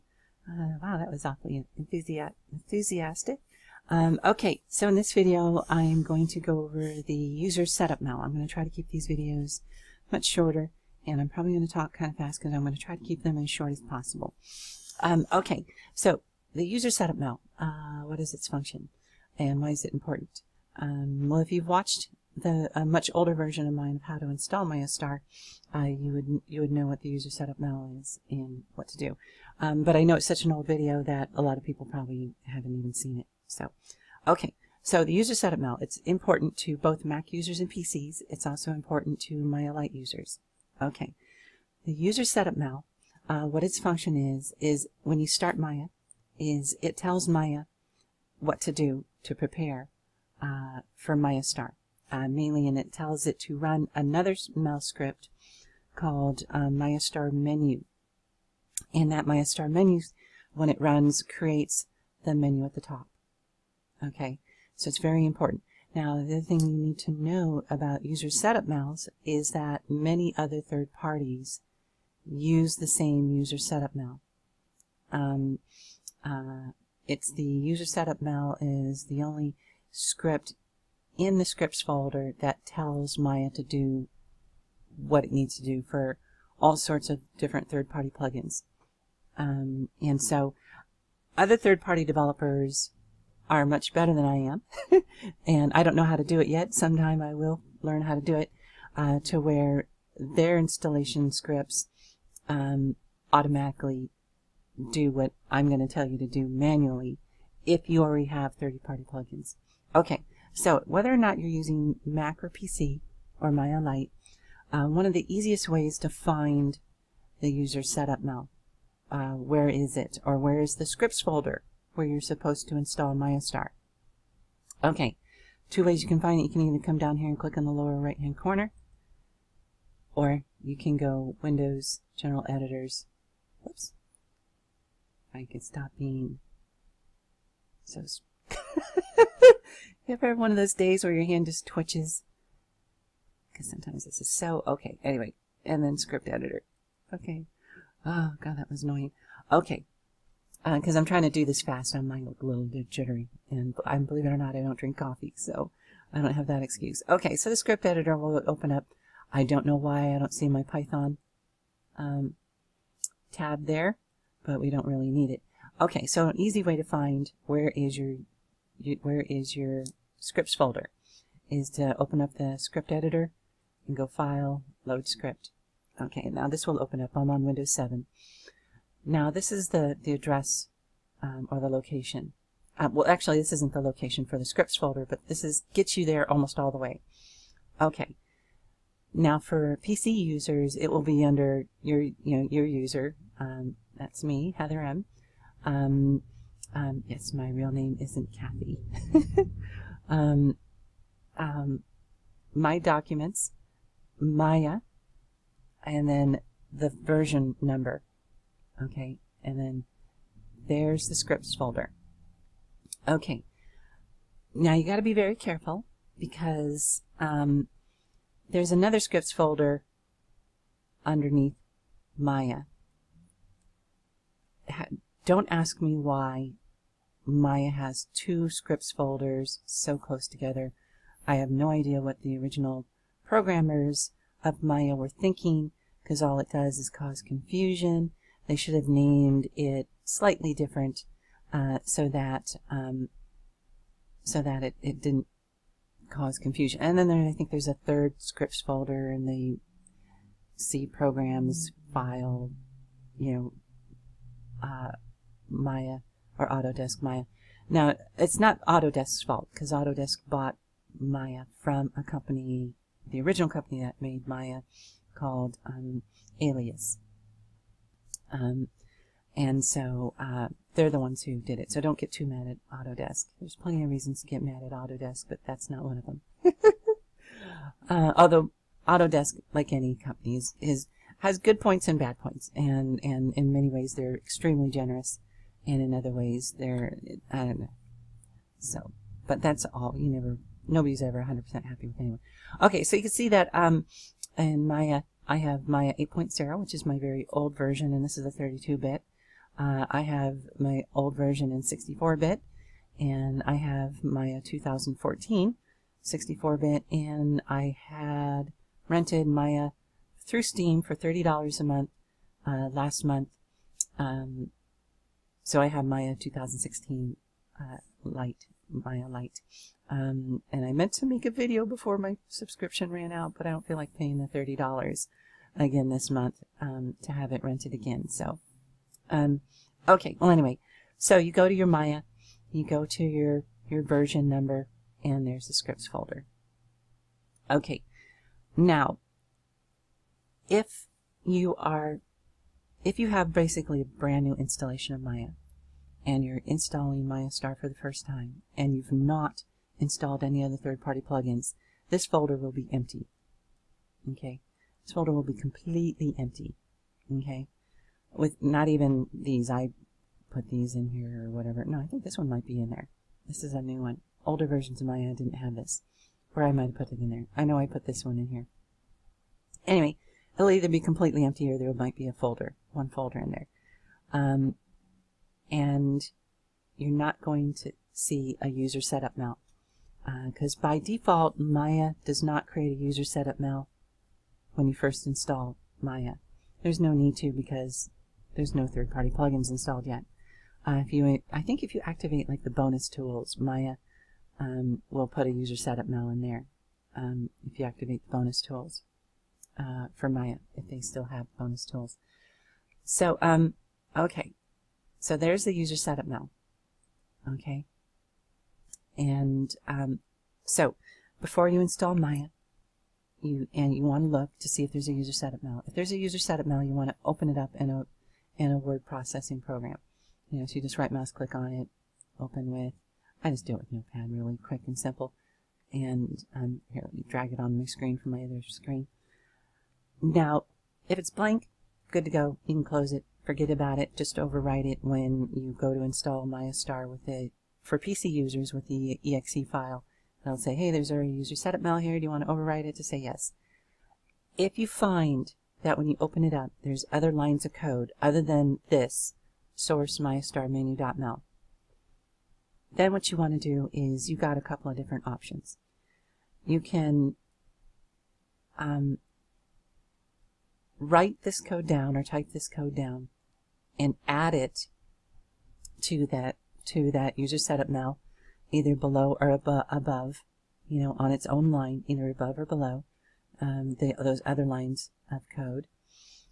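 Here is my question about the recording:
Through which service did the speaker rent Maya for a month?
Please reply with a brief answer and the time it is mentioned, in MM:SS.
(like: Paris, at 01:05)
Steam, at 05:10.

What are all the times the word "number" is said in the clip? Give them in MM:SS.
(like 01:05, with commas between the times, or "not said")
03:27, 05:34.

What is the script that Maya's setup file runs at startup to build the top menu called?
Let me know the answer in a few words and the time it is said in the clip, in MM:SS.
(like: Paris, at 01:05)
MayaStar Menu, at 00:59.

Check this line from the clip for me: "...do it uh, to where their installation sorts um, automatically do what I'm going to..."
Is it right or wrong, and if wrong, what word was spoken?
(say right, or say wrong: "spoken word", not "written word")
wrong: "scripts", not "sorts".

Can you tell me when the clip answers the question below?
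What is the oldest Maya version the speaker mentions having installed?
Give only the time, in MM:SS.
04:55.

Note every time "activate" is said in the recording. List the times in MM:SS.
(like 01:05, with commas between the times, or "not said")
06:31, 06:37.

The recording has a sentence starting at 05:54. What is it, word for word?
Okay, this folder will be completely empty.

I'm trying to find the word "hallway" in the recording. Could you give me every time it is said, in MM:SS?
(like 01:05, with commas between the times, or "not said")
not said.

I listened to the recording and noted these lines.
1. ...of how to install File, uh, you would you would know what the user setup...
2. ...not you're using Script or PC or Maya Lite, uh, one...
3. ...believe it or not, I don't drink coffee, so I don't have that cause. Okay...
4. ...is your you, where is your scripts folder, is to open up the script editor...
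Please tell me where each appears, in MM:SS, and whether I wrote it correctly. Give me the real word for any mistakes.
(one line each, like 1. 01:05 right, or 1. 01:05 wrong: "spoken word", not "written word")
1. 00:23 wrong: "MayaStar", not "File"
2. 01:51 wrong: "Mac", not "Script"
3. 02:33 wrong: "excuse", not "cause"
4. 02:47 right.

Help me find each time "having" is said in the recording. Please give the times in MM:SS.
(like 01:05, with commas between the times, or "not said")
not said.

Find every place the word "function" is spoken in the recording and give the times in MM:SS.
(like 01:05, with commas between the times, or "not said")
00:18, 00:43.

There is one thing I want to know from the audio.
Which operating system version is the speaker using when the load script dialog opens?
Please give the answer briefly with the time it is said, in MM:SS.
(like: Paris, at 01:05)
Windows 7, at 02:57.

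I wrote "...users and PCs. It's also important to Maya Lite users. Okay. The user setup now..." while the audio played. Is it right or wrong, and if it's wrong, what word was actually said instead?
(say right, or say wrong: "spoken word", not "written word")
right.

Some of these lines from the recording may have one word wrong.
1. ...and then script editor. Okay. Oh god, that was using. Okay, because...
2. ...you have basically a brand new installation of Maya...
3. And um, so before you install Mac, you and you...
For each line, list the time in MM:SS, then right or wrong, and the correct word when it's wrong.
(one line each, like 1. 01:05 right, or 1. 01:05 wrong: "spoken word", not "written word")
1. 02:25 wrong: "annoying", not "using"
2. 05:42 right
3. 06:48 wrong: "Maya", not "Mac".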